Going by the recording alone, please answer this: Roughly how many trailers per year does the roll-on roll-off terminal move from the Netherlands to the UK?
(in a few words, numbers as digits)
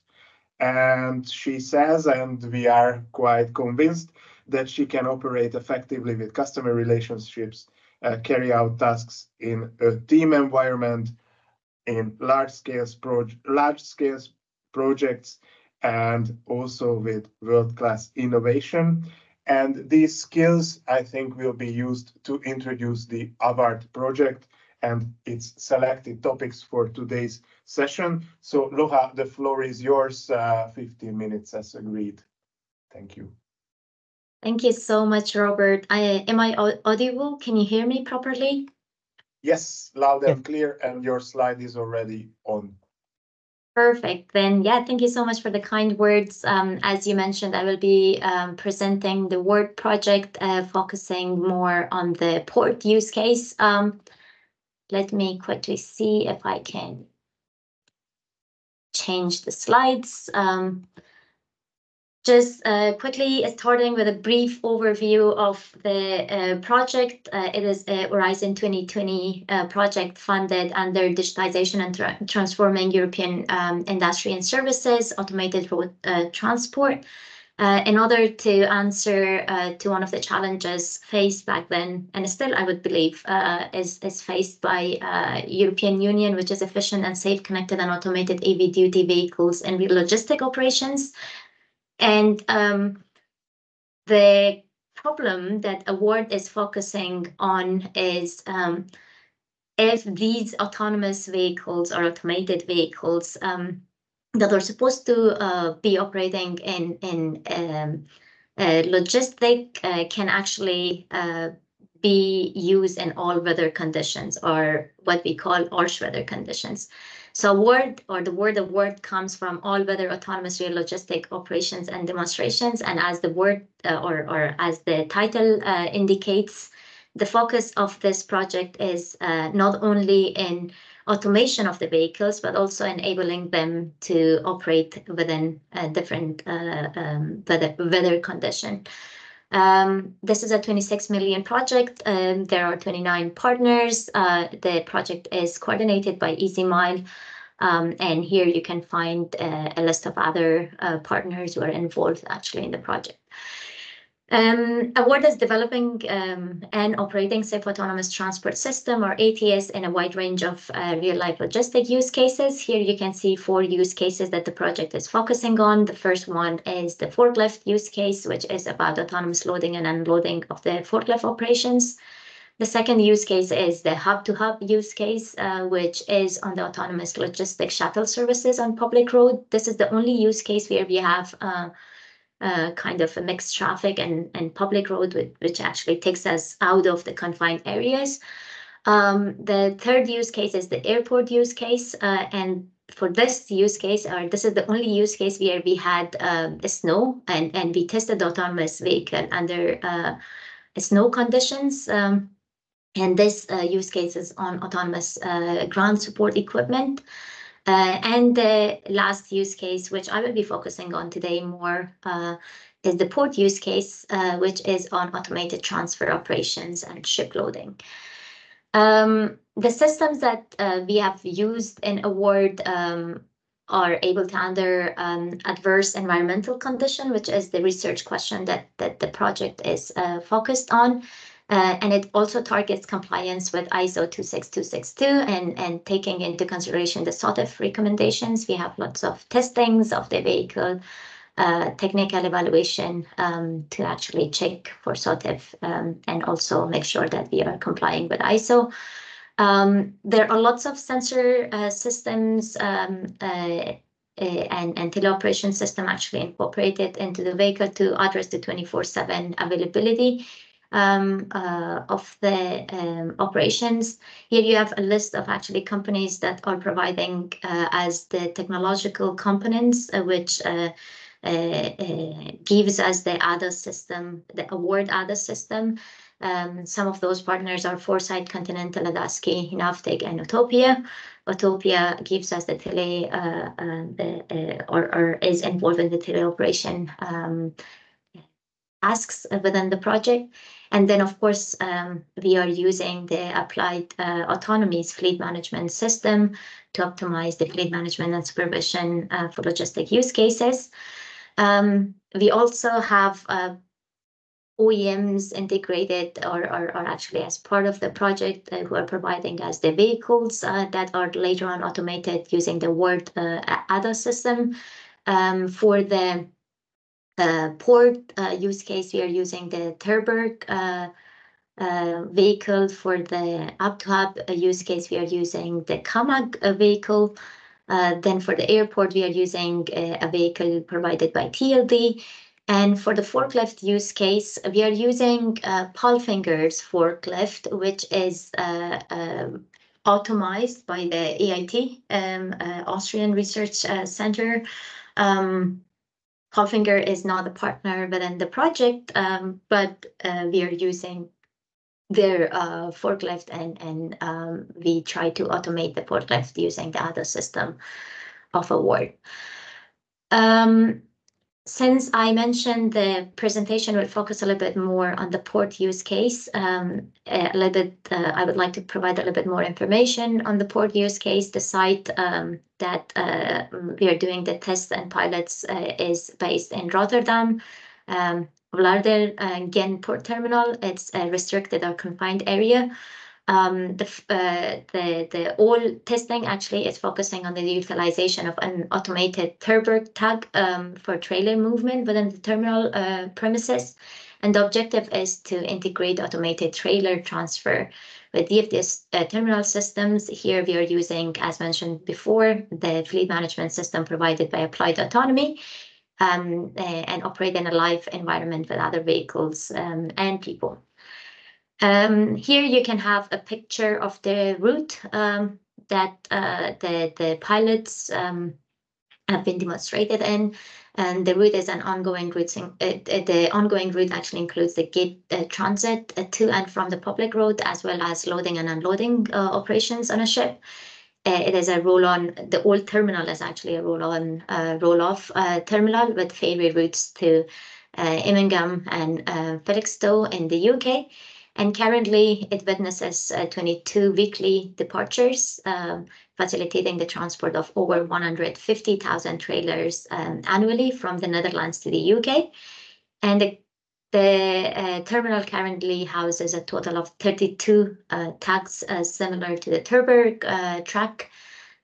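Over 150,000.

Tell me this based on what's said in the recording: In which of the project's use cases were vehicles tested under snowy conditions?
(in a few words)
The airport use case.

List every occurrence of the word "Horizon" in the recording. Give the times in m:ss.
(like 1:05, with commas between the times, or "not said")
1:08.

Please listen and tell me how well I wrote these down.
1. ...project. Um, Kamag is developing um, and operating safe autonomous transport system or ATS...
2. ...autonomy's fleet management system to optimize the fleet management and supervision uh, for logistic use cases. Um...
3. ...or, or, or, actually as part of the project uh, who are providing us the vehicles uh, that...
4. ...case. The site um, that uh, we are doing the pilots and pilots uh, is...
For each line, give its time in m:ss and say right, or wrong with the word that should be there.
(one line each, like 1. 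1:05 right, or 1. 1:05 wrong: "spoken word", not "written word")
1. 2:32 wrong: "AWARD", not "Kamag"
2. 4:54 right
3. 5:06 right
4. 6:10 wrong: "tests", not "pilots".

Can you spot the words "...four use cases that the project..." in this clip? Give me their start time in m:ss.
2:43.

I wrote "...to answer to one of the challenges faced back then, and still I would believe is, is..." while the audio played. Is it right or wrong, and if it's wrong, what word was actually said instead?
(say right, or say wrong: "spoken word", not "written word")
right.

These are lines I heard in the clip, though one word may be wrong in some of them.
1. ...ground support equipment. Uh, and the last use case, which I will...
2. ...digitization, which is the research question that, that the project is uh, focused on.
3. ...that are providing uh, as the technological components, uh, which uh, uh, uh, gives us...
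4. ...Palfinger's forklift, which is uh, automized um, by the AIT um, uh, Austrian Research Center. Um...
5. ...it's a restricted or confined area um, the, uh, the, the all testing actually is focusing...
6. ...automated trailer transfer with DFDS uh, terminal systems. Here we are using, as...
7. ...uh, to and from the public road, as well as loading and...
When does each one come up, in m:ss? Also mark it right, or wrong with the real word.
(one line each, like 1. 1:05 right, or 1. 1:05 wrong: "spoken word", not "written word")
1. 3:25 right
2. 3:46 wrong: "condition", not "digitization"
3. 4:26 right
4. 5:35 right
5. 6:20 right
6. 6:35 right
7. 7:05 right.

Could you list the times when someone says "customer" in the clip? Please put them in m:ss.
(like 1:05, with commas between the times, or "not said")
0:06.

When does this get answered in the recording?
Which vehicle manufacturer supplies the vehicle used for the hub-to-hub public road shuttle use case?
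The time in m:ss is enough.
5:25.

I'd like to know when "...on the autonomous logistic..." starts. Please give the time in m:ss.
2:56.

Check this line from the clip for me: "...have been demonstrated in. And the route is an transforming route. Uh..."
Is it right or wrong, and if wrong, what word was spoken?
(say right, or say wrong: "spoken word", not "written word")
wrong: "ongoing", not "transforming".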